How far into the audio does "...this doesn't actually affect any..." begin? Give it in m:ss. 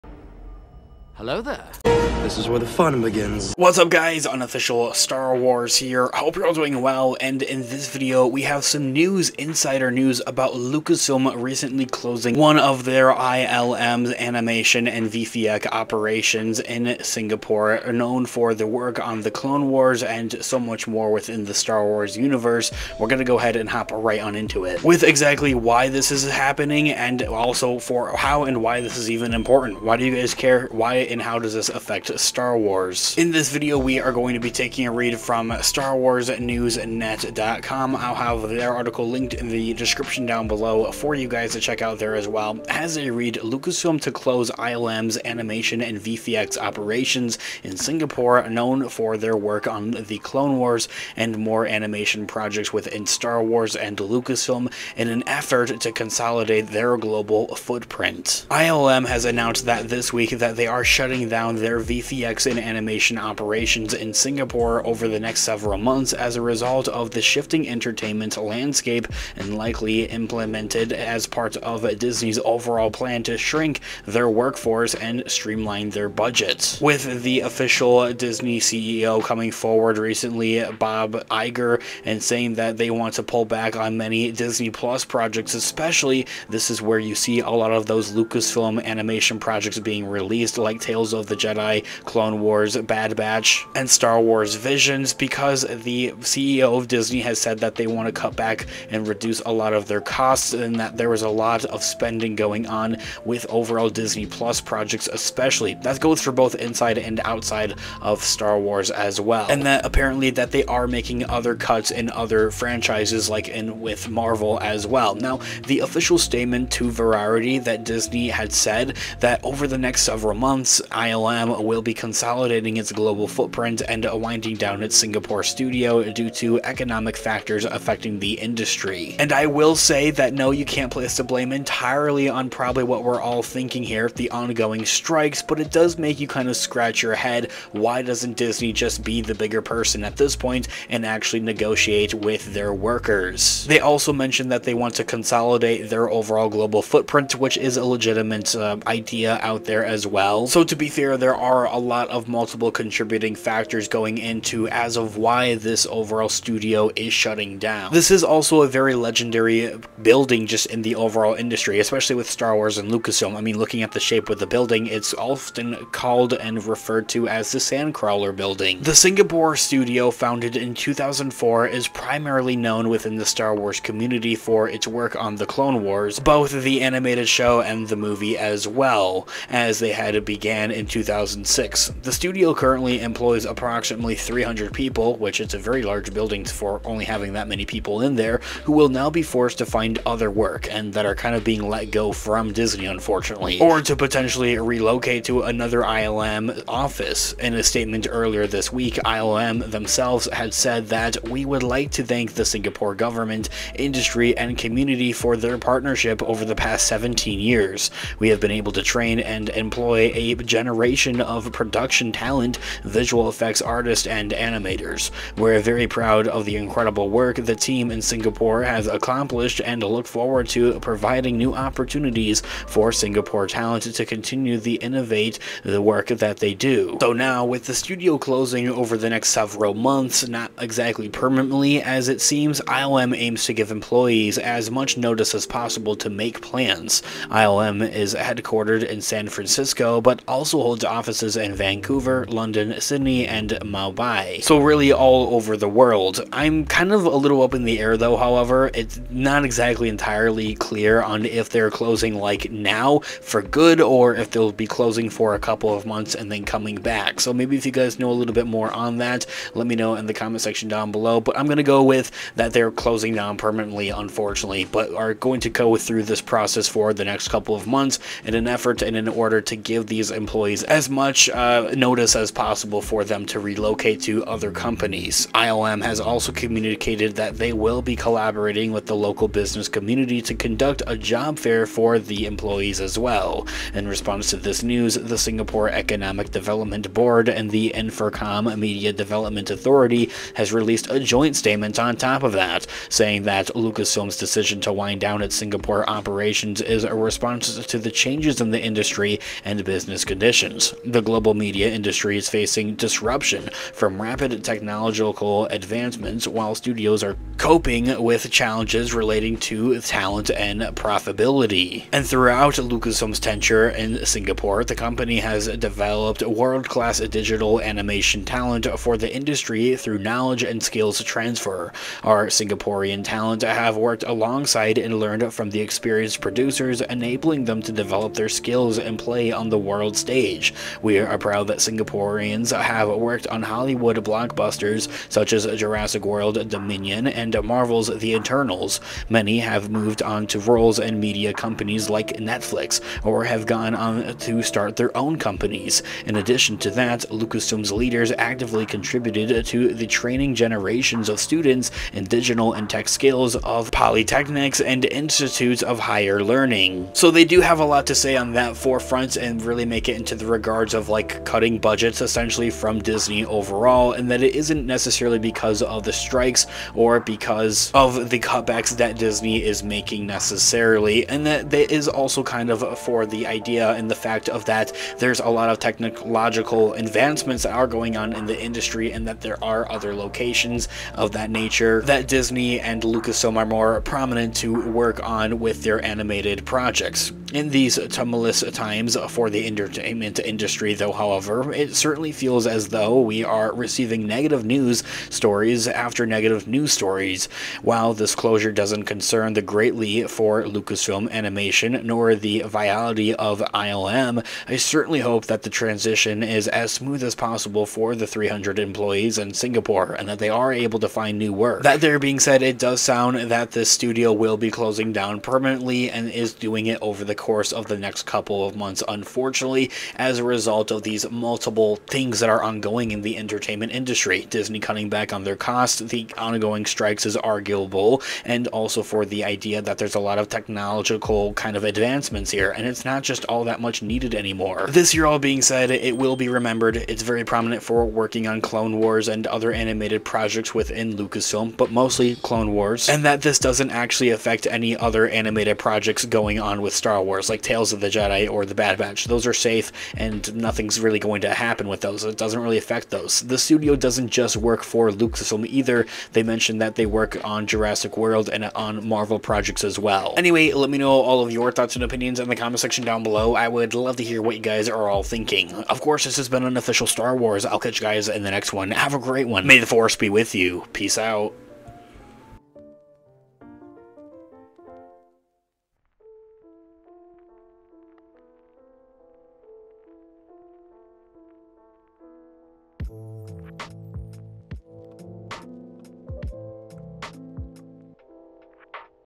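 7:23.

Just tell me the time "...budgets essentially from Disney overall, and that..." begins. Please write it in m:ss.
6:01.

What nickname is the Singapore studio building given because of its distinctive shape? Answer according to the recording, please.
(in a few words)
Sandcrawler building.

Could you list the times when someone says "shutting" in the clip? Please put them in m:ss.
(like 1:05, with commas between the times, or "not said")
1:00, 2:37.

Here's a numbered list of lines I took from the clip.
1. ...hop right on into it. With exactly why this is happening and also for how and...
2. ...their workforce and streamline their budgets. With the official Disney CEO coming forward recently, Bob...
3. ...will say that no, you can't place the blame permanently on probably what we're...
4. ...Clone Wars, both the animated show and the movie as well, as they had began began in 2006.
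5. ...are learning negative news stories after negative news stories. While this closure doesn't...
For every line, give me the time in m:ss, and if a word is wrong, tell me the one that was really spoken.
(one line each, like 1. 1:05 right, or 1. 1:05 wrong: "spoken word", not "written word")
1. 0:23 right
2. 1:14 right
3. 2:09 wrong: "entirely", not "permanently"
4. 2:55 right
5. 6:33 wrong: "receiving", not "learning".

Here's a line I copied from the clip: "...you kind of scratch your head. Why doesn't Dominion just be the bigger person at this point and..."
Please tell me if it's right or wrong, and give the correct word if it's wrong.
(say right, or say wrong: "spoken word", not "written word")
wrong: "Disney", not "Dominion".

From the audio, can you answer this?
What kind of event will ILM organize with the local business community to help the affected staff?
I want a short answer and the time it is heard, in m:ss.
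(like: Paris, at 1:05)
A job fair, at 4:40.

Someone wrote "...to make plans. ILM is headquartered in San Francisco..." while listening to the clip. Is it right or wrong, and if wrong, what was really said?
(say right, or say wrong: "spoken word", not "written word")
right.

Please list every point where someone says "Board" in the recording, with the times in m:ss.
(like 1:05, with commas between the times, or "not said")
4:46.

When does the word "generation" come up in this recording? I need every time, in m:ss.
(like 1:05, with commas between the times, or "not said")
3:30, 5:50.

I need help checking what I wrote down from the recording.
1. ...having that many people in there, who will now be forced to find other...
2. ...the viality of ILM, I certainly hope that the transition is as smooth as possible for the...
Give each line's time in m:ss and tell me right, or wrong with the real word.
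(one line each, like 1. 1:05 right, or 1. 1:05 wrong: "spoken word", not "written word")
1. 3:07 right
2. 6:42 right.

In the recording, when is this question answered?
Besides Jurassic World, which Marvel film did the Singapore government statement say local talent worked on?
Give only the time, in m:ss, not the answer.
5:37.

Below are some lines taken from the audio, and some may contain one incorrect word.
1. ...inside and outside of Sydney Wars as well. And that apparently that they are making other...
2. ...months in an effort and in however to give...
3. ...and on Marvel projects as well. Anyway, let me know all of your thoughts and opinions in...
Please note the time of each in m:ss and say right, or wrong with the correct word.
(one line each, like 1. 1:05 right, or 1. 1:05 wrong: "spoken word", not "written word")
1. 1:46 wrong: "Star", not "Sydney"
2. 4:27 wrong: "order", not "however"
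3. 7:38 right.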